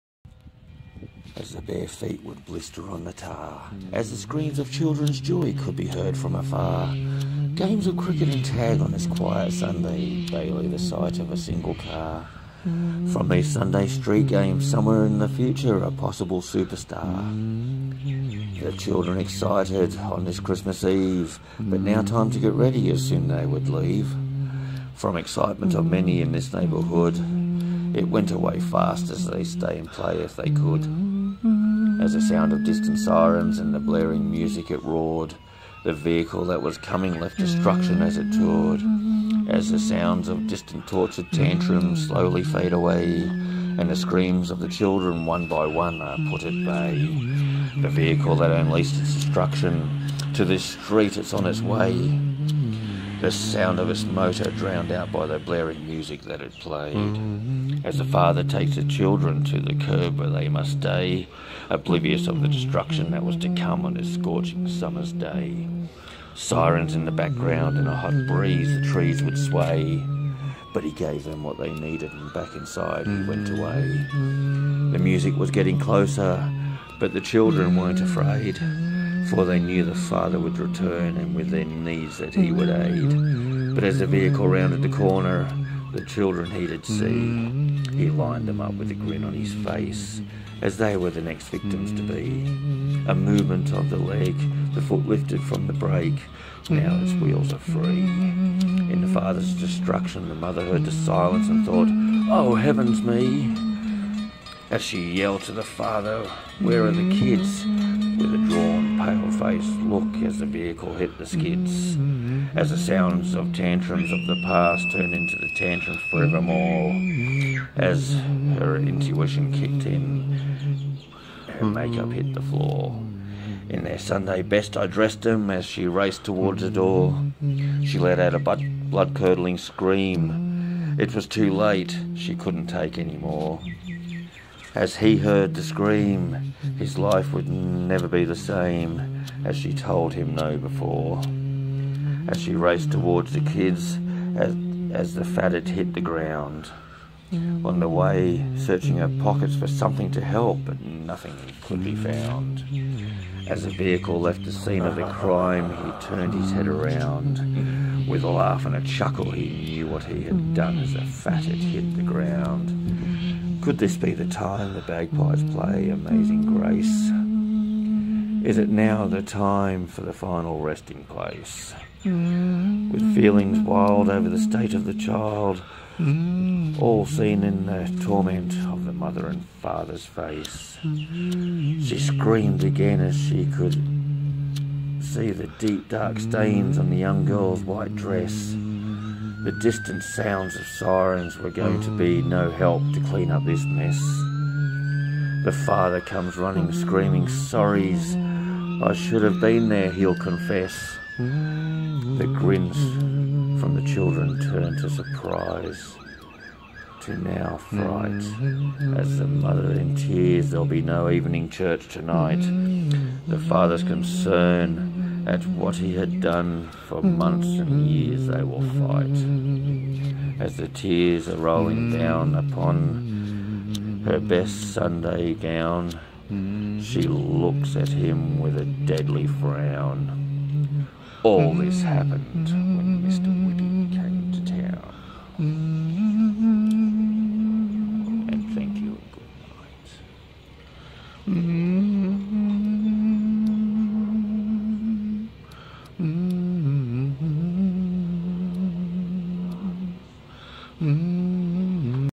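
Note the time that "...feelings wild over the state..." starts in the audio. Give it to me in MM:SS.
02:53.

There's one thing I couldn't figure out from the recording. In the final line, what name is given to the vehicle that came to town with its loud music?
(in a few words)
Mr. Whippy.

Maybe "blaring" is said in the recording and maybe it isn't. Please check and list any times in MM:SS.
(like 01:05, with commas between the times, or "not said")
00:33, 00:55.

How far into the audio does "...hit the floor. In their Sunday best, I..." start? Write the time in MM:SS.
02:02.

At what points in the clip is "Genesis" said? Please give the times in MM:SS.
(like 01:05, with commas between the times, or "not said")
not said.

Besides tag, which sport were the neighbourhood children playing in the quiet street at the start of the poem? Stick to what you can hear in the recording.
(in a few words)
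cricket.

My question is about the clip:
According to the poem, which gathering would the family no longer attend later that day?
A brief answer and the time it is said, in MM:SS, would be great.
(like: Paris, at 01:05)
evening church, at 03:31.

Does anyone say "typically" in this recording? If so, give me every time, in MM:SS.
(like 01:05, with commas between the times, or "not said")
not said.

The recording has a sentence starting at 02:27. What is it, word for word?
On the way, searching her pockets for something to help, but nothing could be found.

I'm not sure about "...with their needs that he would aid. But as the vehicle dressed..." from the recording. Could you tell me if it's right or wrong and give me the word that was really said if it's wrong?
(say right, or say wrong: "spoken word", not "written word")
wrong: "rounded", not "dressed".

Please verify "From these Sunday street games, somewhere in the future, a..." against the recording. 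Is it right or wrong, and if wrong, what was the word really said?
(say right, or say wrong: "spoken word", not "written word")
right.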